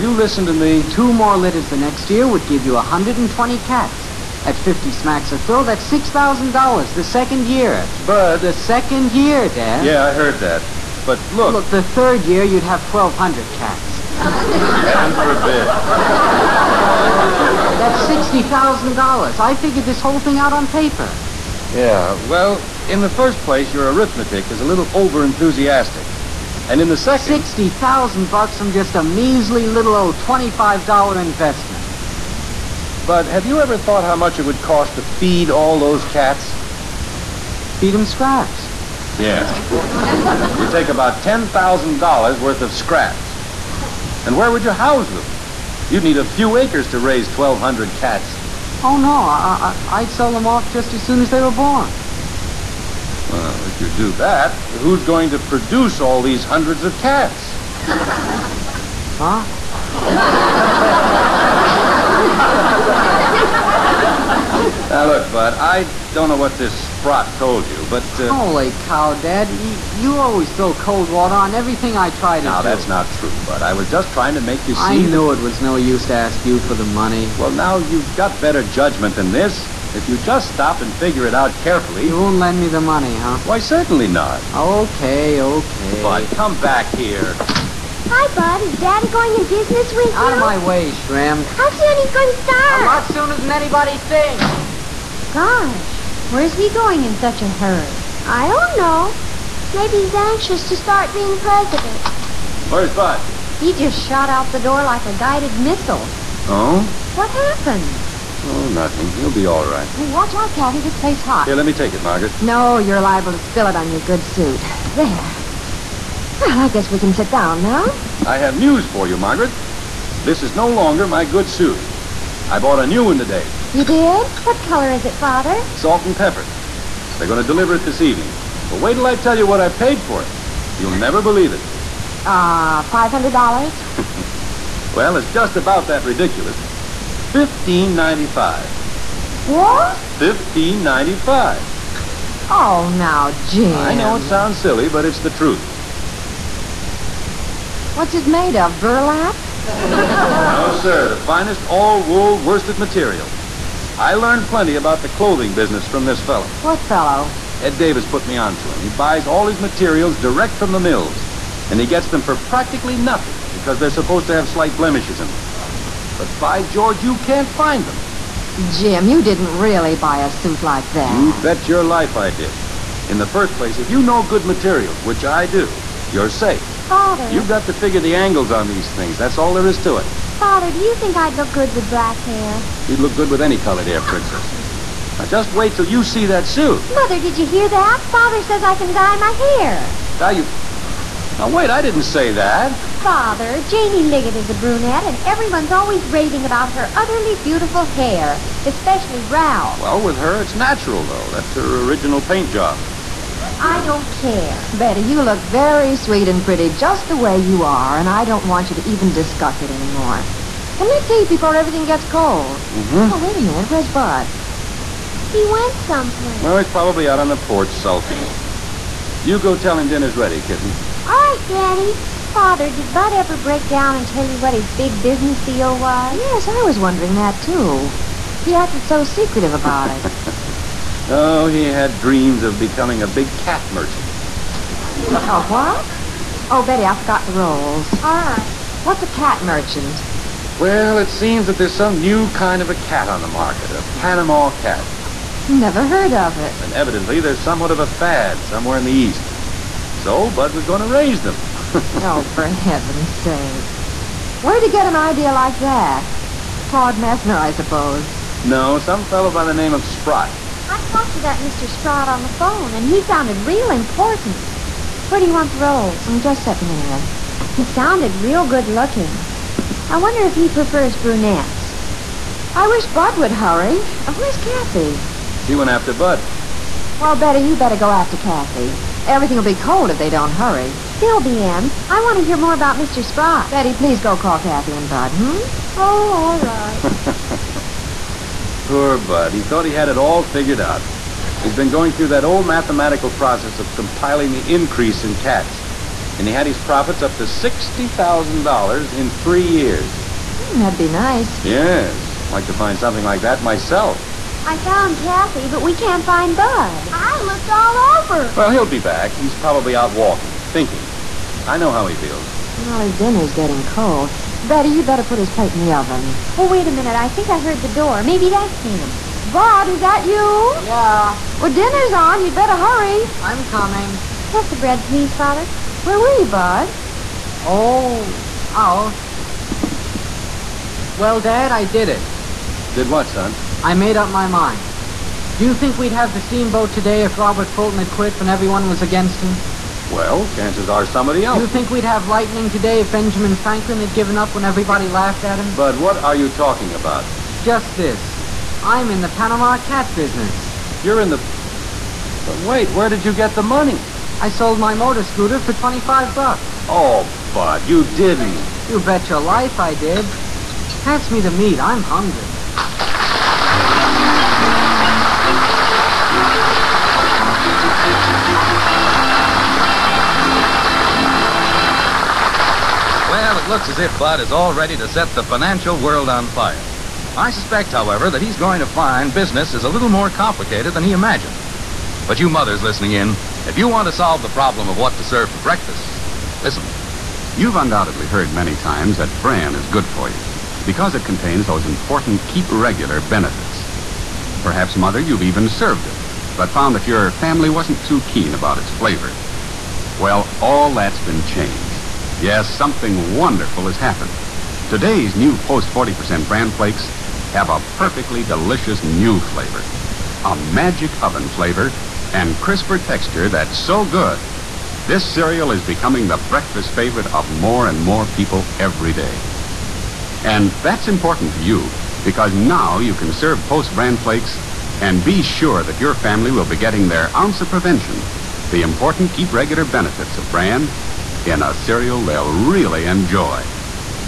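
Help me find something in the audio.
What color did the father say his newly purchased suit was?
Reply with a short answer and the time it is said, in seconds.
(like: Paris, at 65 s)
Salt and pepper, at 125 s.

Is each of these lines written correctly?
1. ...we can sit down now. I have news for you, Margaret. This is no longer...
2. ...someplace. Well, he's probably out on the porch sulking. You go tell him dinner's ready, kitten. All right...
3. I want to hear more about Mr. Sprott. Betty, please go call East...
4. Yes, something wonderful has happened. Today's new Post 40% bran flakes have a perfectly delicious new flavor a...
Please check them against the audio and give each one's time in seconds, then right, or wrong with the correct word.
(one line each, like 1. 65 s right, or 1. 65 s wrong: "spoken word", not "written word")
1. 116 s right
2. 215 s right
3. 281 s wrong: "Kathy", not "East"
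4. 402 s right.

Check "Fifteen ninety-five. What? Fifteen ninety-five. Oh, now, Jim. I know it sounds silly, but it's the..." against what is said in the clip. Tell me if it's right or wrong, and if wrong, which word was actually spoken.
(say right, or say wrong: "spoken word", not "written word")
right.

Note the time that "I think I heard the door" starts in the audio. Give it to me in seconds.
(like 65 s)
316 s.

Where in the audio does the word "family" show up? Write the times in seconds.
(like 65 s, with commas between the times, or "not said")
397 s, 425 s.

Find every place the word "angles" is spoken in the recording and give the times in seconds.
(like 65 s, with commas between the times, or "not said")
178 s.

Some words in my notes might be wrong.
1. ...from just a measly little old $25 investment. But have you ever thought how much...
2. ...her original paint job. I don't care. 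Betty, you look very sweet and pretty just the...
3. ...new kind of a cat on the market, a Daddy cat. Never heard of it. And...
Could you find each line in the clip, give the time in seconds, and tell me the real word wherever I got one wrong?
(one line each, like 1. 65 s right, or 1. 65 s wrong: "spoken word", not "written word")
1. 28 s right
2. 201 s right
3. 241 s wrong: "Panama", not "Daddy".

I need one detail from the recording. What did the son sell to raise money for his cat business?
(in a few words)
Motor scooter.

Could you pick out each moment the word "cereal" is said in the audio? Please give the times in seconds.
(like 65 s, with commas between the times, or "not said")
415 s, 431 s.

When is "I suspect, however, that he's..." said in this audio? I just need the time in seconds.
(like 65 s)
377 s.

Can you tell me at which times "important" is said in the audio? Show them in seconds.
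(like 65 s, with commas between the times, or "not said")
263 s, 391 s, 420 s, 428 s.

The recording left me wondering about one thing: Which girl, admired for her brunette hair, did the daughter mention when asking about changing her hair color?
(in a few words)
Janie Liggett.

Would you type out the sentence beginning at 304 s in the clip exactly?
I found Kathy, but we can't find Bud.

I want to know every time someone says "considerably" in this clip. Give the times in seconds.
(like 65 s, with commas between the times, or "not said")
not said.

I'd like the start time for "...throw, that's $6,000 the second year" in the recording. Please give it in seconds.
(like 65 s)
5 s.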